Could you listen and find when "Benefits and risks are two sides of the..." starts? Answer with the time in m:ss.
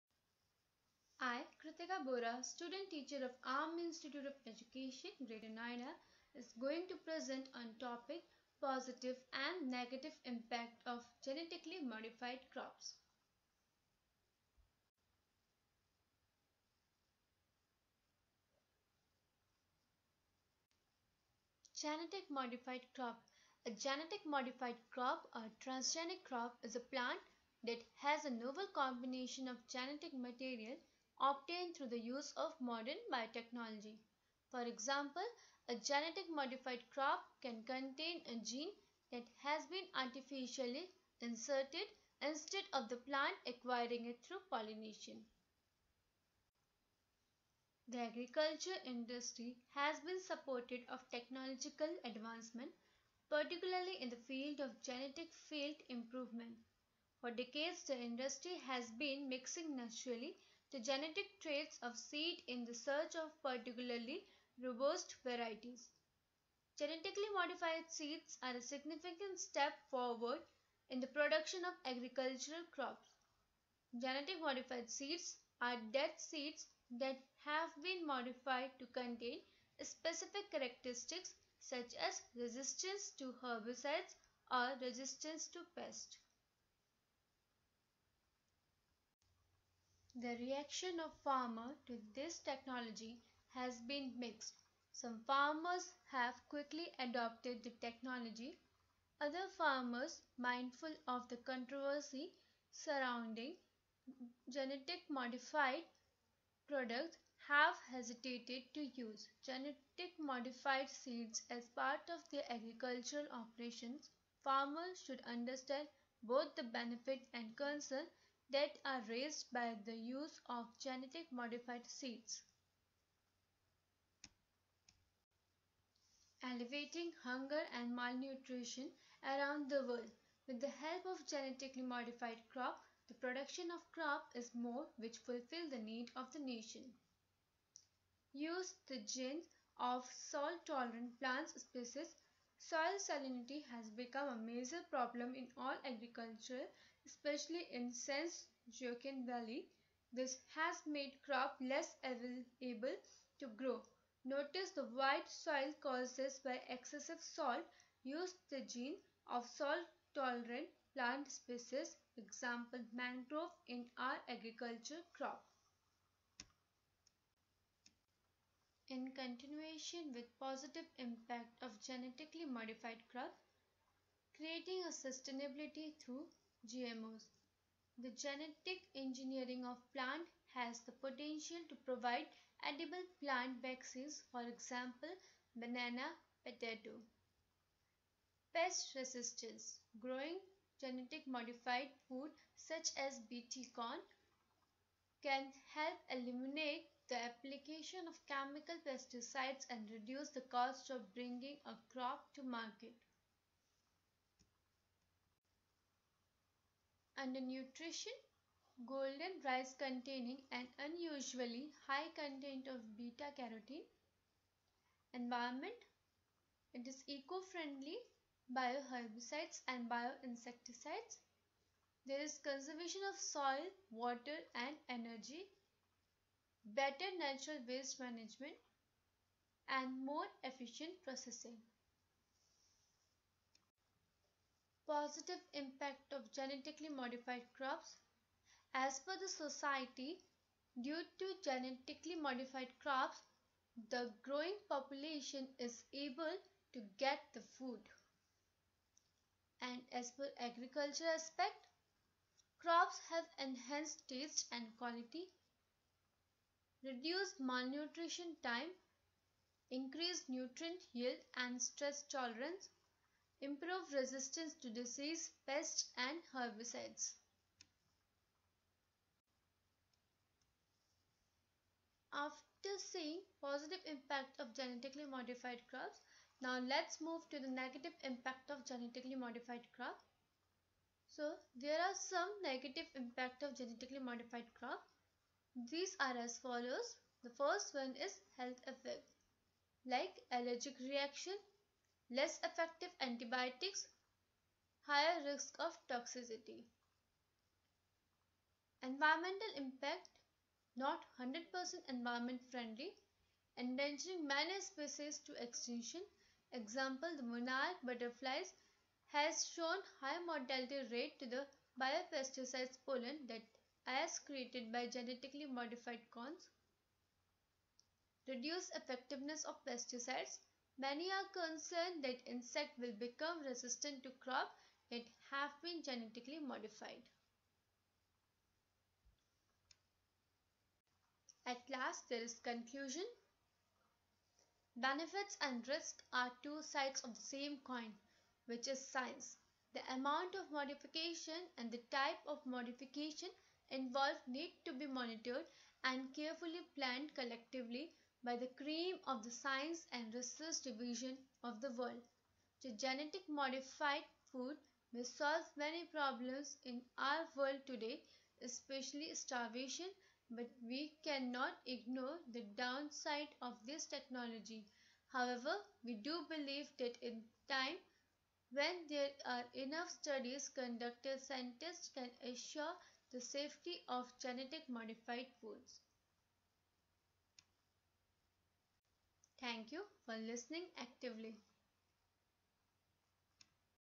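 5:34.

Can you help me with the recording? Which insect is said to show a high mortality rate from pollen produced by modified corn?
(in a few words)
monarch butterflies.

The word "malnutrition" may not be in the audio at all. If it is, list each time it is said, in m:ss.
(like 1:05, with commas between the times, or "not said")
2:07, 4:17.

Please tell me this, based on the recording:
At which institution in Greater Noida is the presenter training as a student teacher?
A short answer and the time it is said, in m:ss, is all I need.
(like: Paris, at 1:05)
Army Institute of Education, at 0:03.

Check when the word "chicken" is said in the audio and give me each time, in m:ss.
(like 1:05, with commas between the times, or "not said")
not said.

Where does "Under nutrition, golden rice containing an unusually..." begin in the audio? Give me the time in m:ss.
3:27.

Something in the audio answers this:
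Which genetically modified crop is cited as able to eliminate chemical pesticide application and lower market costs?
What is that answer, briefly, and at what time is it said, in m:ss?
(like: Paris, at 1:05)
BT corn, at 3:13.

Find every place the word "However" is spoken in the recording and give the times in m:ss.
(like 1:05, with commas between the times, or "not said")
6:05.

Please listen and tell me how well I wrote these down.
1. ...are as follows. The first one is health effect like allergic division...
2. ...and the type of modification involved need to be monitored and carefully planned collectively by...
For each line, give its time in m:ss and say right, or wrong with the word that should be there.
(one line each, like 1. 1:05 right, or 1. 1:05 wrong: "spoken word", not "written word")
1. 4:45 wrong: "reaction", not "division"
2. 5:41 right.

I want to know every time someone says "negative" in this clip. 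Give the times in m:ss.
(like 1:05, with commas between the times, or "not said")
0:09, 4:37, 4:42.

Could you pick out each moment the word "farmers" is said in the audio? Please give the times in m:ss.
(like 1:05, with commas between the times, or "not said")
1:31, 1:35, 1:39, 1:54.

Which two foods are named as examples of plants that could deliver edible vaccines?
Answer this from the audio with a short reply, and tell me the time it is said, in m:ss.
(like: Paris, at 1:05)
banana, potato, at 3:05.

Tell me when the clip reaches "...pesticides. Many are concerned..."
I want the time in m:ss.
5:19.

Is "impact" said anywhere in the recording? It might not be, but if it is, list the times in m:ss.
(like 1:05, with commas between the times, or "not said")
0:10, 2:50, 3:55, 4:33, 4:38, 4:42, 4:59.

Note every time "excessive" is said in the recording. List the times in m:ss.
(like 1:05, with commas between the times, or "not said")
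2:36.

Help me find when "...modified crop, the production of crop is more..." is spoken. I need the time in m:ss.
2:11.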